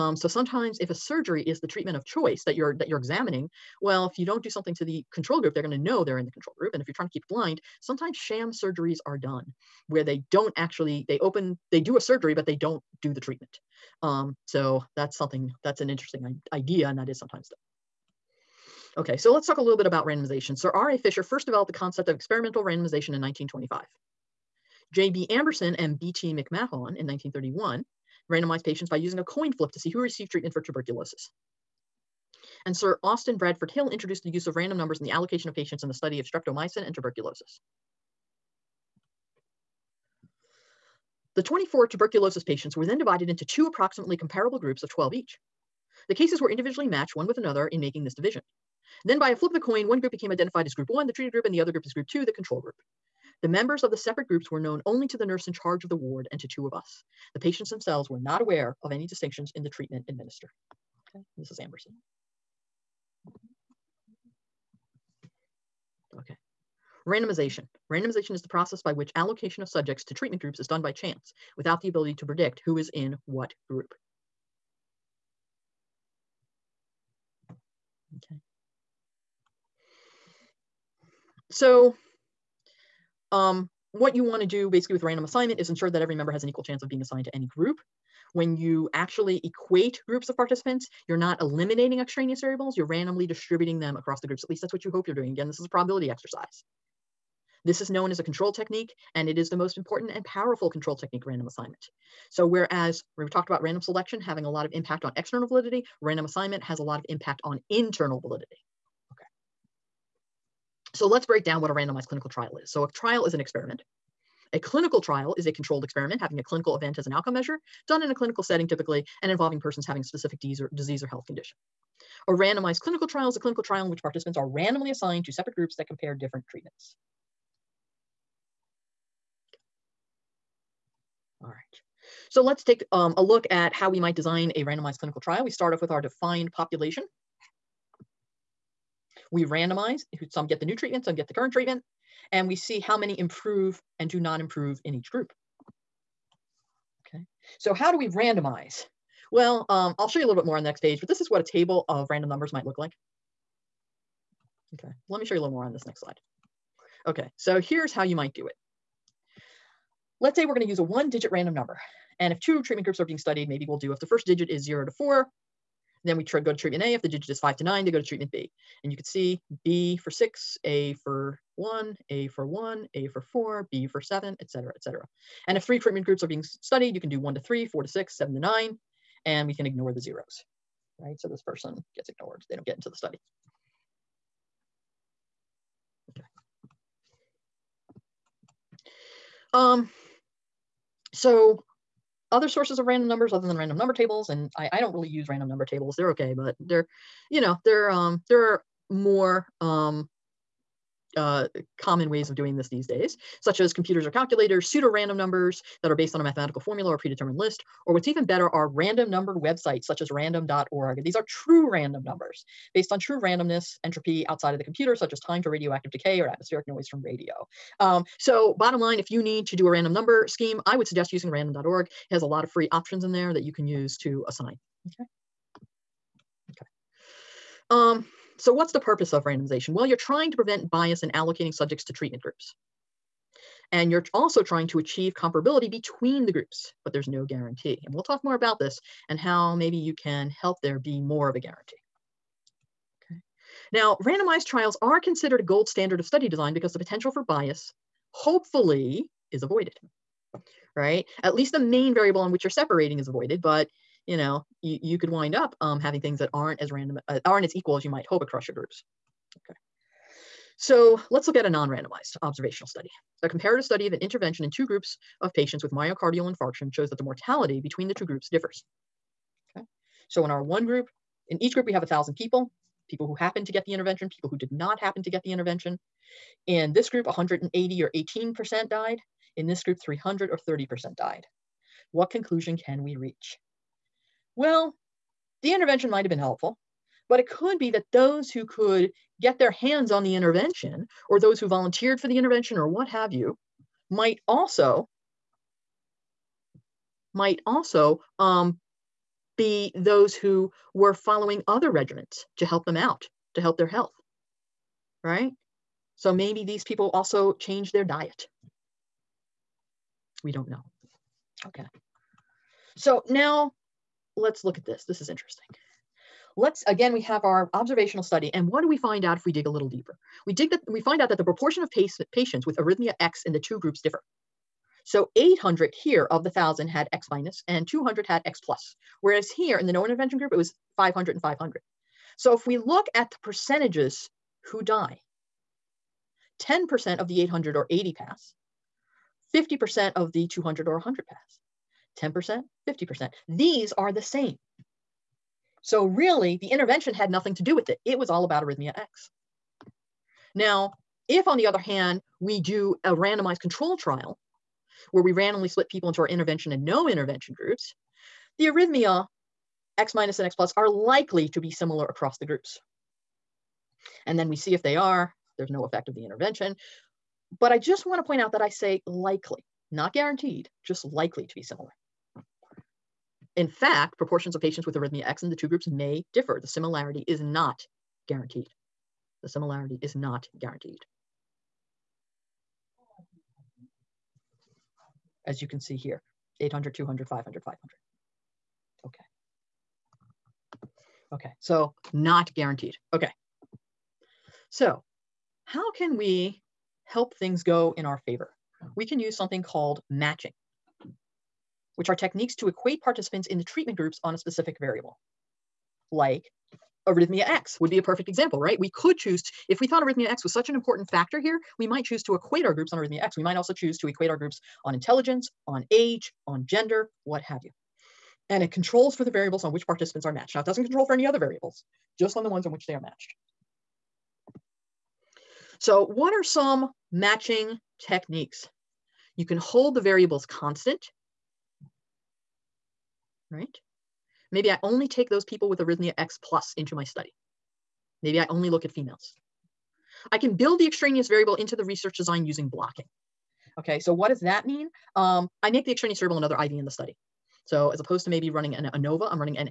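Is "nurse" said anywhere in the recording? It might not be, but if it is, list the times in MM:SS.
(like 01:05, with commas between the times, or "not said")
00:55.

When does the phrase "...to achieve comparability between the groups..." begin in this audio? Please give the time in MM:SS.
03:54.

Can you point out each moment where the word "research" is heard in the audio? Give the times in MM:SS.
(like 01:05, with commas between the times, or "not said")
07:21.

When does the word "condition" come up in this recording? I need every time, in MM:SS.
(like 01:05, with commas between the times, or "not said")
02:01.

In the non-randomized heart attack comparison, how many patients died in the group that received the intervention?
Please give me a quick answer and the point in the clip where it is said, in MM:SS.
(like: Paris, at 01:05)
180, at 04:37.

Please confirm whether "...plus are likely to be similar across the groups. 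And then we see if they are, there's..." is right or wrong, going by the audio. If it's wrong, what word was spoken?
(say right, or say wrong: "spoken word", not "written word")
right.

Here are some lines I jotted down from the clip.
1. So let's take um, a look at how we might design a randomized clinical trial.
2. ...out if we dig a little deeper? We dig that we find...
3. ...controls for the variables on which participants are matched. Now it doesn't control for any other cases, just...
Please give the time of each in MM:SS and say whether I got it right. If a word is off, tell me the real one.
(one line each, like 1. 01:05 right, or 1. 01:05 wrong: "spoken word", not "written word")
1. 02:12 right
2. 05:19 right
3. 06:58 wrong: "variables", not "cases".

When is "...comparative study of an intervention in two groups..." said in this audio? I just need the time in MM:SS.
04:23.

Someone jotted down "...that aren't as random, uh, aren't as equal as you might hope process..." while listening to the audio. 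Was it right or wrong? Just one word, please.
wrong.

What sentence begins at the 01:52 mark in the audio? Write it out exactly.
So a trial is an experiment.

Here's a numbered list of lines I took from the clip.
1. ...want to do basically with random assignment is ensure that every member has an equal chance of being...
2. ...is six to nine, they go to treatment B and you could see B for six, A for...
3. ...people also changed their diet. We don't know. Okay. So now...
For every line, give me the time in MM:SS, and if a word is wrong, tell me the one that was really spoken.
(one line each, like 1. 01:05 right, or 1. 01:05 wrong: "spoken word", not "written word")
1. 01:24 right
2. 02:47 wrong: "five", not "six"
3. 05:06 right.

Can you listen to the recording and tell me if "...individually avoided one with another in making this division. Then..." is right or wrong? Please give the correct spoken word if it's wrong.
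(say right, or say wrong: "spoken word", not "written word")
wrong: "matched", not "avoided".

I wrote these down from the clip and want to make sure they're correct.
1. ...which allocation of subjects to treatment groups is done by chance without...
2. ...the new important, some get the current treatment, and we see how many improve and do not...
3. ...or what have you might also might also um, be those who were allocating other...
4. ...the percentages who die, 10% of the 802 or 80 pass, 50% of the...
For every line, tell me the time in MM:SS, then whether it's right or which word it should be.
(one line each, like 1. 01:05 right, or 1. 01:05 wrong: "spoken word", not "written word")
1. 01:08 right
2. 02:20 wrong: "treatment", not "important"
3. 04:52 wrong: "following", not "allocating"
4. 05:33 wrong: "800", not "802".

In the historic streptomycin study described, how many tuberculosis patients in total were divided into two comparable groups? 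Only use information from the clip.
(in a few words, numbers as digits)
24.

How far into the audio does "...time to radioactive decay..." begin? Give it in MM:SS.
03:35.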